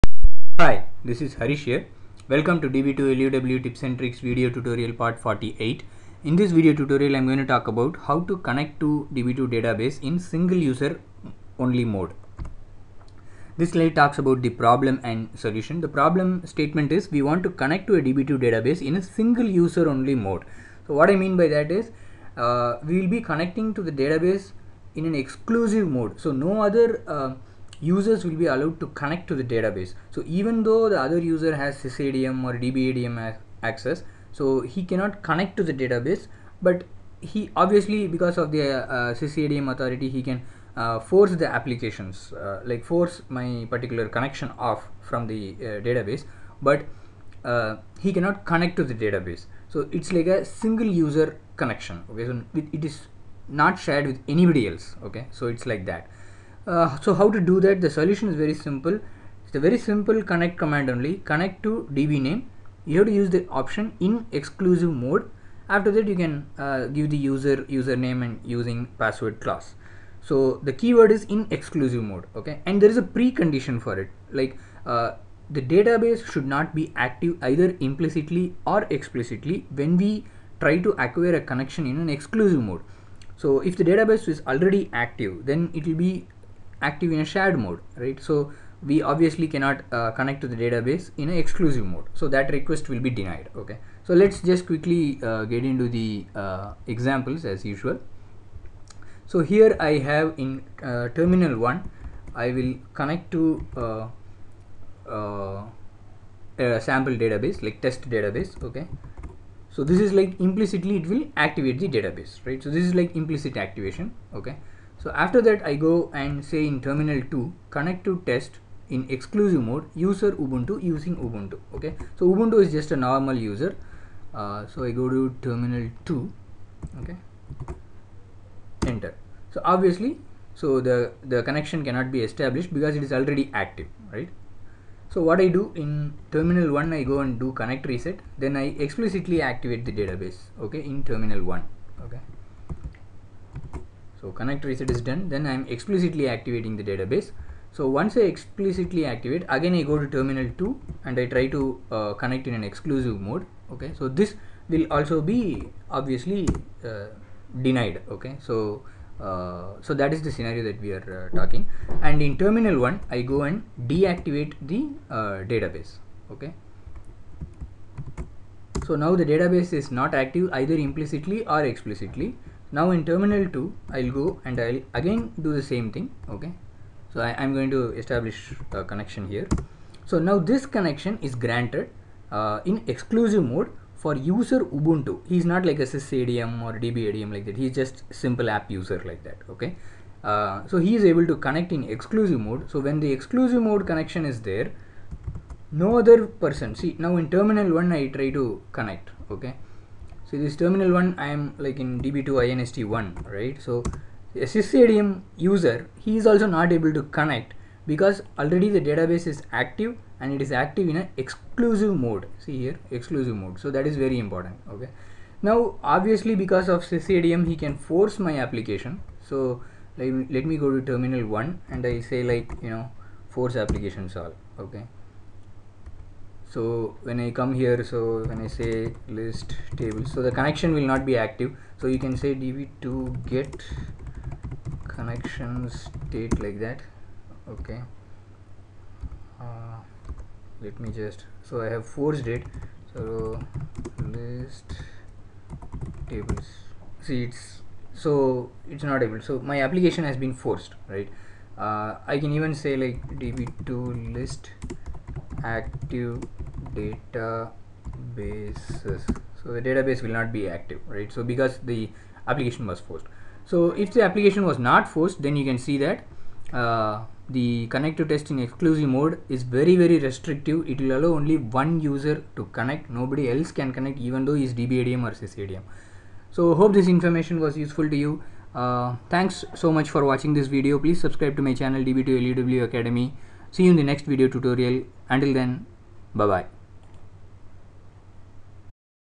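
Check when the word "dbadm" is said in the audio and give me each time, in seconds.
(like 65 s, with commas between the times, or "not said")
32 s, 186 s, 274 s.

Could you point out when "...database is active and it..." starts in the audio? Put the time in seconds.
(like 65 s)
208 s.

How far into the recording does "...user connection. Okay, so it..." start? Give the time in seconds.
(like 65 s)
50 s.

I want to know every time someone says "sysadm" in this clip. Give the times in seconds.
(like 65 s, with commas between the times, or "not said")
31 s, 185 s, 204 s, 216 s, 275 s.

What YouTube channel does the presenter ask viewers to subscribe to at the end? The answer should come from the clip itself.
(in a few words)
DB2LUW Academy.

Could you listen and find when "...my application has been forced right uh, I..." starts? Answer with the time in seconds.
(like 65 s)
249 s.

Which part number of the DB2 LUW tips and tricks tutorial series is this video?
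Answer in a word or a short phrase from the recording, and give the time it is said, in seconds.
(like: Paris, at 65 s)
48, at 4 s.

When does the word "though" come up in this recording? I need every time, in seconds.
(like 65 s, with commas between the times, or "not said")
30 s, 274 s.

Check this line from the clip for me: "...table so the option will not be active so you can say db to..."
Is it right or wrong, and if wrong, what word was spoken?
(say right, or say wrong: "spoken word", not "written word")
wrong: "connection", not "option".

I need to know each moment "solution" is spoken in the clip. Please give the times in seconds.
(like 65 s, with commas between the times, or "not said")
15 s, 57 s.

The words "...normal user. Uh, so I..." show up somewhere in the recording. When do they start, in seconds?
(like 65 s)
122 s.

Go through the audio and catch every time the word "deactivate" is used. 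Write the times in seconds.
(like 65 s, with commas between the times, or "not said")
163 s.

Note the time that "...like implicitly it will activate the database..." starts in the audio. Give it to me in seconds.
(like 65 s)
110 s.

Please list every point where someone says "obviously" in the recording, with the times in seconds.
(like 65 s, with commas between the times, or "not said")
37 s, 89 s, 129 s, 155 s, 215 s.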